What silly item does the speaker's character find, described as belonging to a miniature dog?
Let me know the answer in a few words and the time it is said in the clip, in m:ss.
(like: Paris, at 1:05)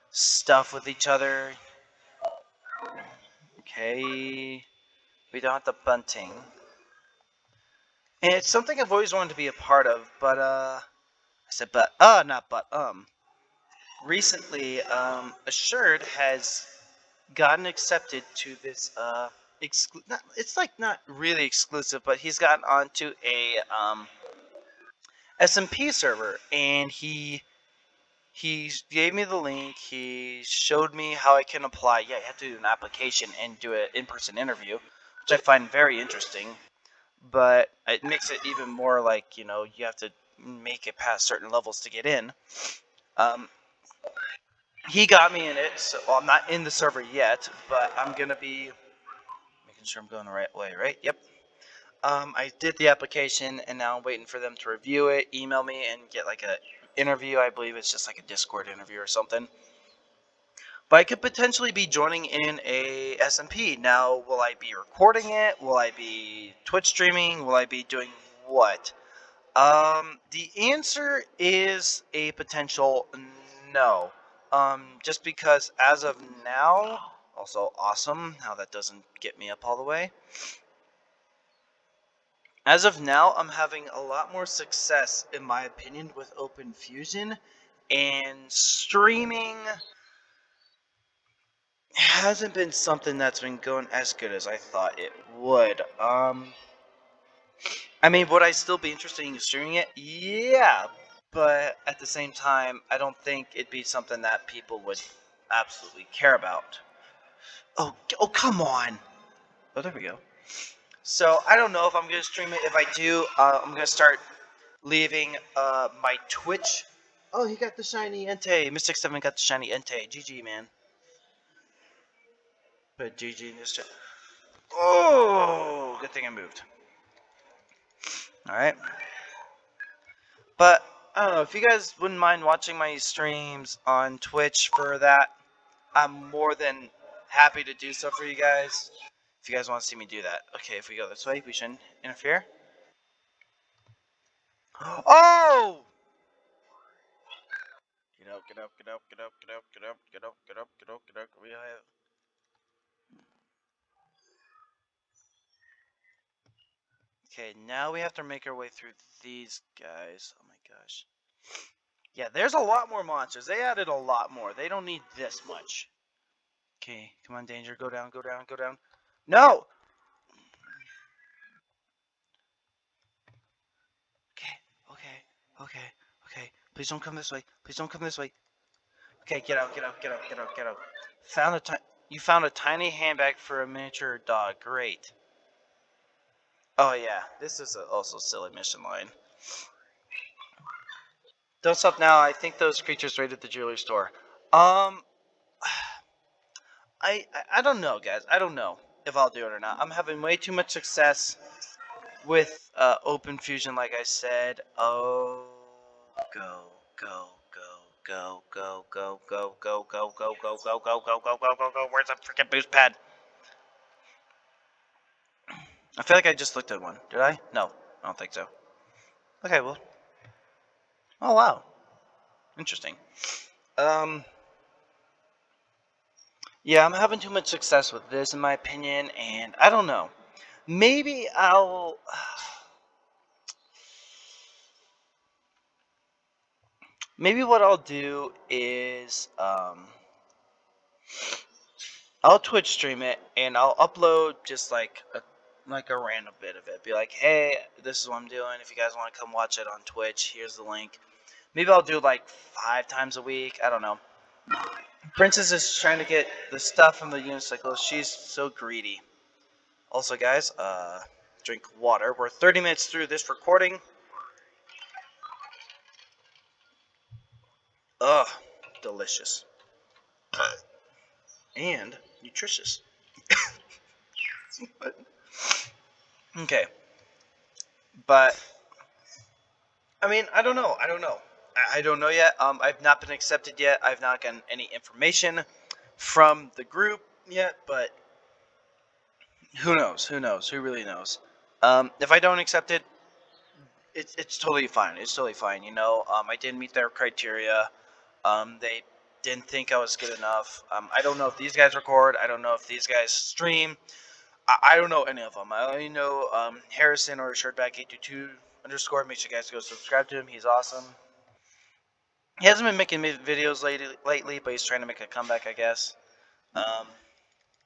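tiny handbag, at 3:02.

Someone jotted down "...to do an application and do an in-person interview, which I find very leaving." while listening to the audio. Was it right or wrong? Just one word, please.
wrong.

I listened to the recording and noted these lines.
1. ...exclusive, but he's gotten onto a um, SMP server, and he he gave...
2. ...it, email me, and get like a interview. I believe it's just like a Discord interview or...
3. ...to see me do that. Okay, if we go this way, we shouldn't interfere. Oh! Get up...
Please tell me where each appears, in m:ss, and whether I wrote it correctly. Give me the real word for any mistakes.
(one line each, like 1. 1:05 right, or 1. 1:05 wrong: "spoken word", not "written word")
1. 0:21 right
2. 0:55 right
3. 2:19 right.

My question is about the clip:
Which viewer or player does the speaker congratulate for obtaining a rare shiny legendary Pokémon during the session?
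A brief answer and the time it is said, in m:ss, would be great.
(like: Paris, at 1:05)
Mystic 7, at 1:58.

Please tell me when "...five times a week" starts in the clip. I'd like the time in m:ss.
4:12.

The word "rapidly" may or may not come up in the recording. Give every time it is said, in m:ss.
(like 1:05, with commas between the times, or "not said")
not said.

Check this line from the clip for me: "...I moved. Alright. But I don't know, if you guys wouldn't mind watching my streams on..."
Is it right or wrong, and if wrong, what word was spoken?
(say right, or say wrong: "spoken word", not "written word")
right.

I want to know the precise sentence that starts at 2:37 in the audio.
Okay, now we have to make our way through these guys gosh.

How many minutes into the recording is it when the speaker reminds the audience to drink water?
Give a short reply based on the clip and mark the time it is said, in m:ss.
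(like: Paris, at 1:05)
30, at 4:22.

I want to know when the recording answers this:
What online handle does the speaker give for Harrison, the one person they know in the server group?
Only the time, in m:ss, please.
5:07.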